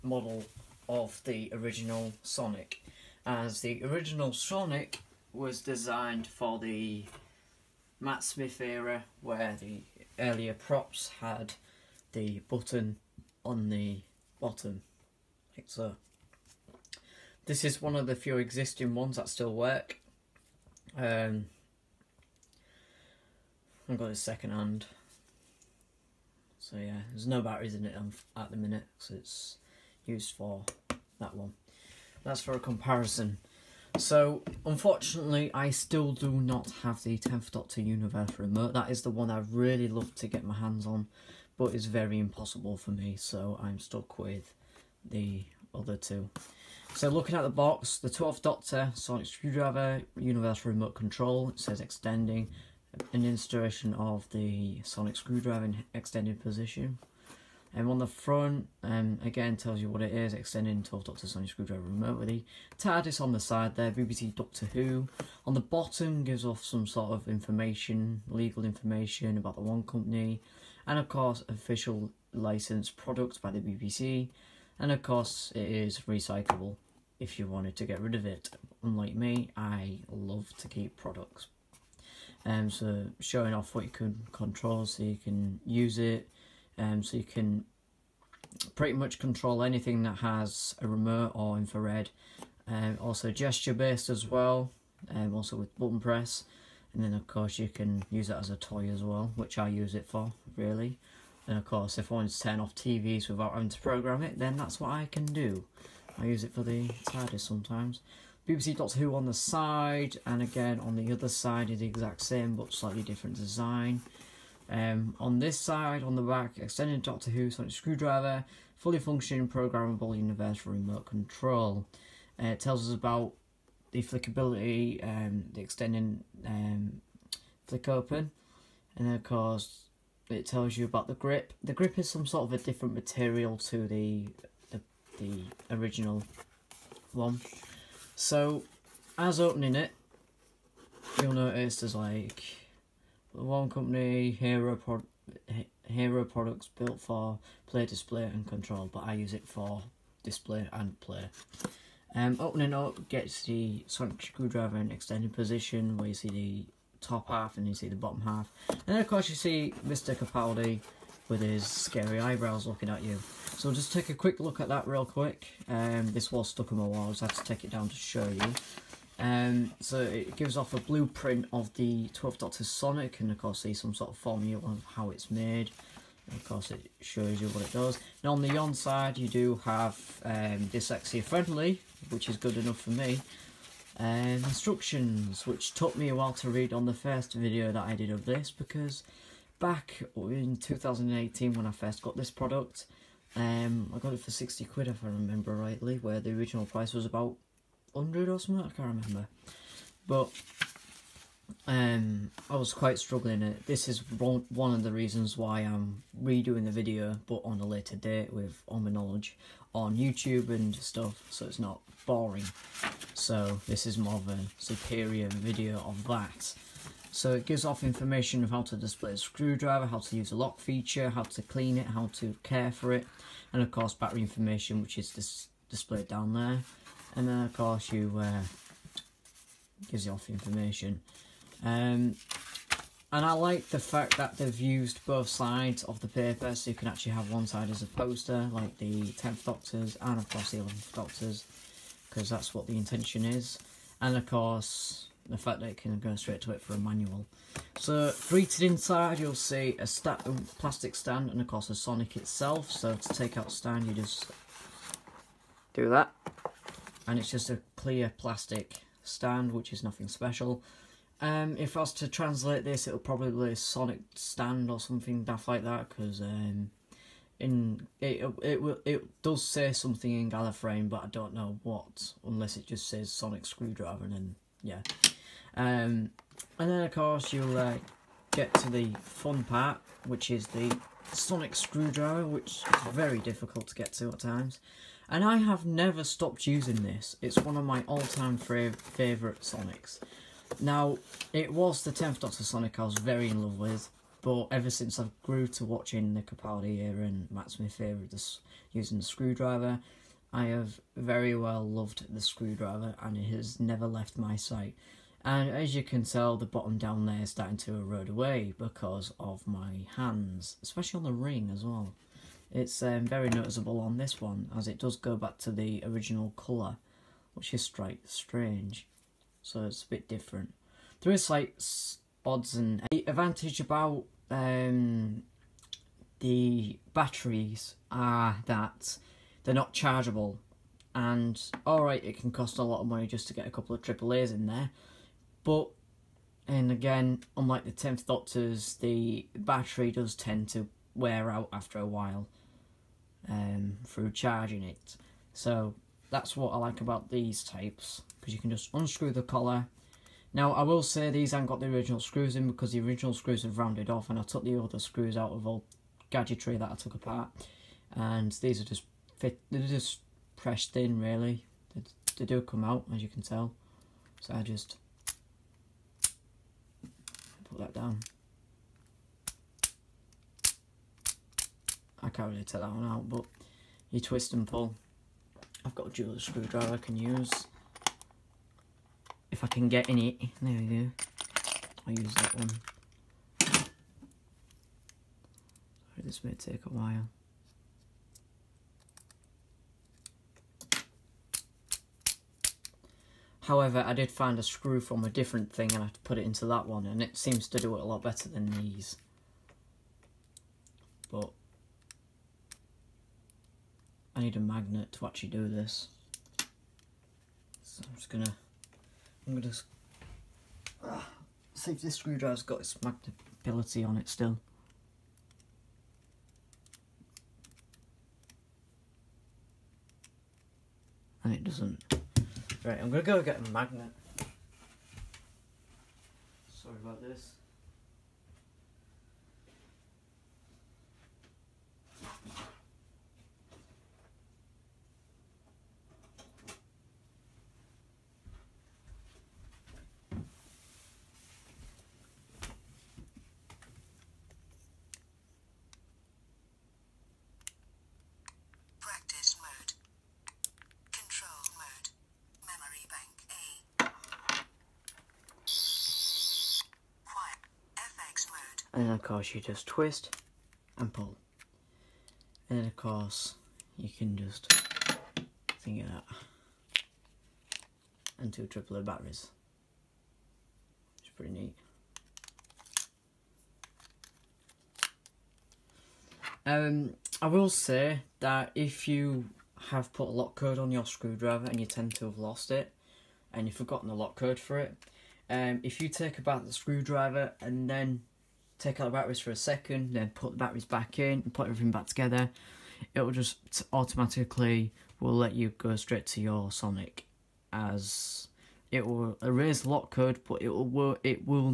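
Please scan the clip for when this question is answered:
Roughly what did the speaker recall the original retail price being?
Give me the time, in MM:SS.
03:17.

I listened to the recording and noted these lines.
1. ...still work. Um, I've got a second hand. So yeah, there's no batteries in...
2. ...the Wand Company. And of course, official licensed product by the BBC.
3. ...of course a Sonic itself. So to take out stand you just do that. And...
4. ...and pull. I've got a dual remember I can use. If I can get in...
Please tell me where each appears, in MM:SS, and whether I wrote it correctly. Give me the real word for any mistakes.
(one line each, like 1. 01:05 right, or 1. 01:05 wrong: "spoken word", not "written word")
1. 00:19 right
2. 01:09 right
3. 04:11 right
4. 06:14 wrong: "screwdriver", not "remember".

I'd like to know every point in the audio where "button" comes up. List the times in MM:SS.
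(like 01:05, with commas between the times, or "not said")
00:12, 01:35.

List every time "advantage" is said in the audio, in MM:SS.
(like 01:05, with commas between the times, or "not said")
05:23.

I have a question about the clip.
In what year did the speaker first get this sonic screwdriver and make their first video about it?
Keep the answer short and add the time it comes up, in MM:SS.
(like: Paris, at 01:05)
2018, at 03:10.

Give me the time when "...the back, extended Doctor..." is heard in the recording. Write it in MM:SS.
01:56.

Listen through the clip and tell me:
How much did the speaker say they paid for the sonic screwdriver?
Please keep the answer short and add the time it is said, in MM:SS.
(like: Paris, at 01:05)
60 quid, at 03:14.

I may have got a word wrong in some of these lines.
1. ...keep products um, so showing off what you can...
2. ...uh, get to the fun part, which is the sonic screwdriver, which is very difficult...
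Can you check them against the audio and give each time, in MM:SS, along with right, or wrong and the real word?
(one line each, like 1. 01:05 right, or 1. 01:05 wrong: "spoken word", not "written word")
1. 01:20 right
2. 04:37 right.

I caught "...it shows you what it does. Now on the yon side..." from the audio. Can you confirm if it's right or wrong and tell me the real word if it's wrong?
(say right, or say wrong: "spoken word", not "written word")
right.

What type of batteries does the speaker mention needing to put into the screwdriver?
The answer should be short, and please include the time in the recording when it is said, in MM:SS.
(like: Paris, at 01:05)
AAA, at 05:33.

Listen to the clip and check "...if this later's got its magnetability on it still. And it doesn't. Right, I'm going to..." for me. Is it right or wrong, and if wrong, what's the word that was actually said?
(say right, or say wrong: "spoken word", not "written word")
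wrong: "screwdriver", not "later".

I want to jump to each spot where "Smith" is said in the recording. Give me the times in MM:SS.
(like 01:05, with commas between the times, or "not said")
00:08, 04:57.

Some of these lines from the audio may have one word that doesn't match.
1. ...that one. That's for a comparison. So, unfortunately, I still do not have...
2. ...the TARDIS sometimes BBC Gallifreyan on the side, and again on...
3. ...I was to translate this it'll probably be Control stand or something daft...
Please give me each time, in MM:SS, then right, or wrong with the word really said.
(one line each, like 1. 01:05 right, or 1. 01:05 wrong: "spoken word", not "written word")
1. 00:31 right
2. 01:46 wrong: "Who", not "Gallifreyan"
3. 04:21 wrong: "Sonic", not "Control".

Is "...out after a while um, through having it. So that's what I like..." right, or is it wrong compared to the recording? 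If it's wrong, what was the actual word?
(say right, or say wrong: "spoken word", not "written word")
wrong: "charging", not "having".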